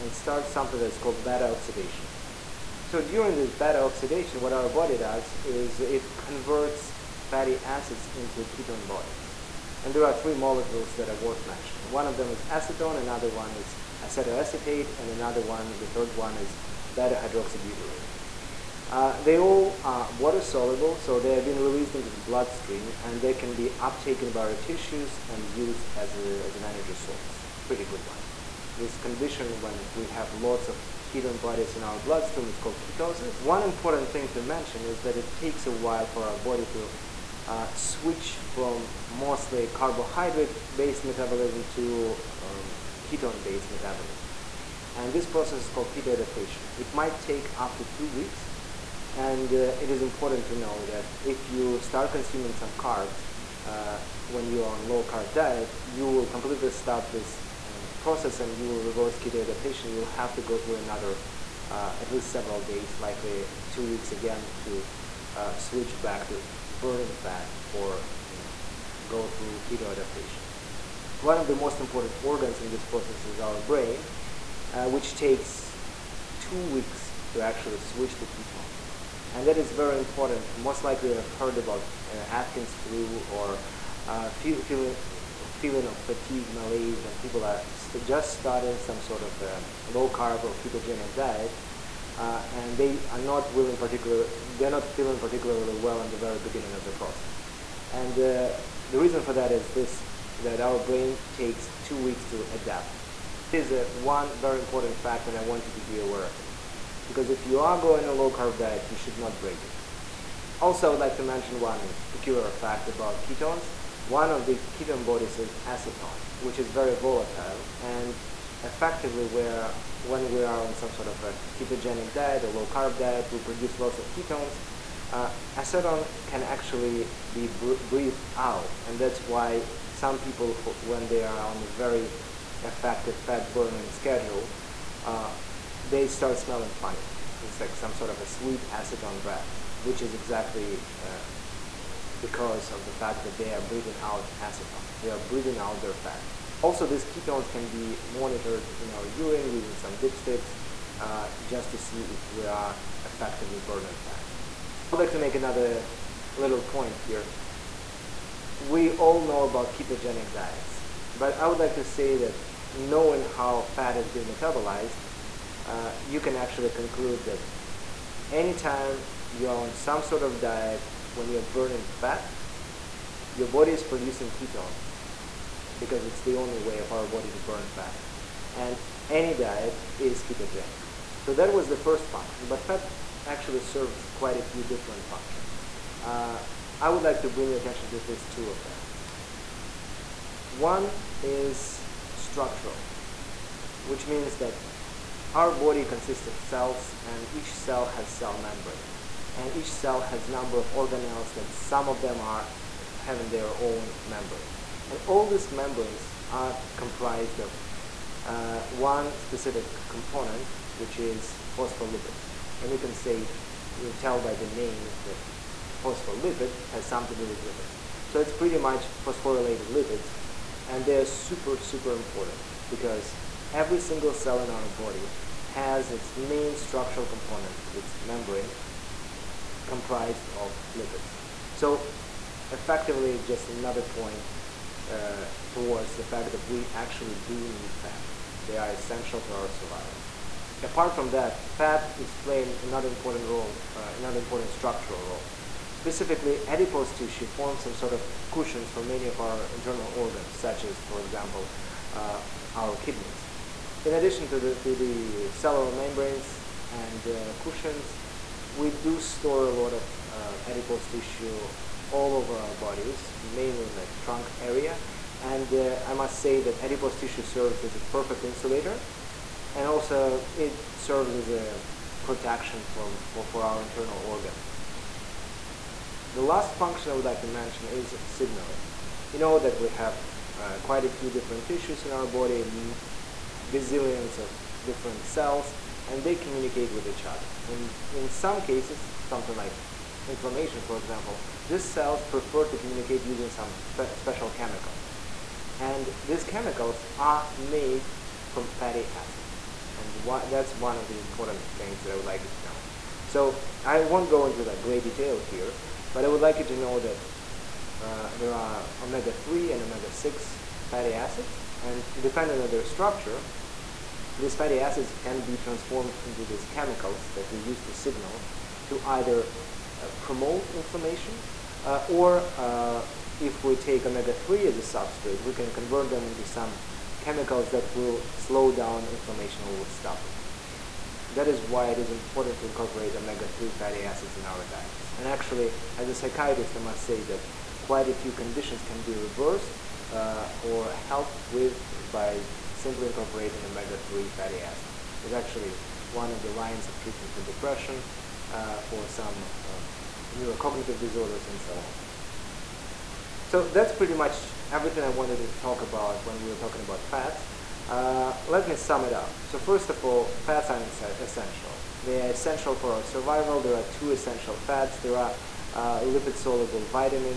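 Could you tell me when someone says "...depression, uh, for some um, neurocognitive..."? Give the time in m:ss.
5:47.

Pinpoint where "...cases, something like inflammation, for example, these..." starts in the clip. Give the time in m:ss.
4:48.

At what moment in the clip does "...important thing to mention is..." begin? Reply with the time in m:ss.
0:33.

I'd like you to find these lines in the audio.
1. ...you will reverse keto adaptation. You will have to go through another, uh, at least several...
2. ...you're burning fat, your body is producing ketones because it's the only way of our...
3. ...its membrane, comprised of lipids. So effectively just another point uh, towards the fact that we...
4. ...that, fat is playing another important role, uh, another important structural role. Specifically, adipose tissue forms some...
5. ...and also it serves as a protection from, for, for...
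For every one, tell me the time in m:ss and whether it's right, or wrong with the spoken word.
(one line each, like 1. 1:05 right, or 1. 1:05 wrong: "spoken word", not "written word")
1. 0:58 right
2. 2:51 right
3. 3:47 right
4. 4:01 right
5. 4:29 right.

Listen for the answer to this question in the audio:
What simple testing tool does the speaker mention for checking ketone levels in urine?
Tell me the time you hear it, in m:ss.
2:29.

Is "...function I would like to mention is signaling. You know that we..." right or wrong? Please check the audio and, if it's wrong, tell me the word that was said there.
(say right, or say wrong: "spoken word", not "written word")
right.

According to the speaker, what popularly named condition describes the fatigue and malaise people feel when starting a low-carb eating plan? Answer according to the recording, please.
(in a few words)
Atkins flu.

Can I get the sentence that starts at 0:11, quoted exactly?
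One of them is acetone, another one is acetoacetate, and another one, the third one is beta hydroxybutyrate.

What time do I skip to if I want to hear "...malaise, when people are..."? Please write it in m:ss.
1:26.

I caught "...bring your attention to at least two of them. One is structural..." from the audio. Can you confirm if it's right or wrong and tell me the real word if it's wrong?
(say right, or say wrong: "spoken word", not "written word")
right.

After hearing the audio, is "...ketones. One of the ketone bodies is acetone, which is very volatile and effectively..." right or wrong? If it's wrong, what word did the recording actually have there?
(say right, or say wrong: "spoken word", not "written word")
right.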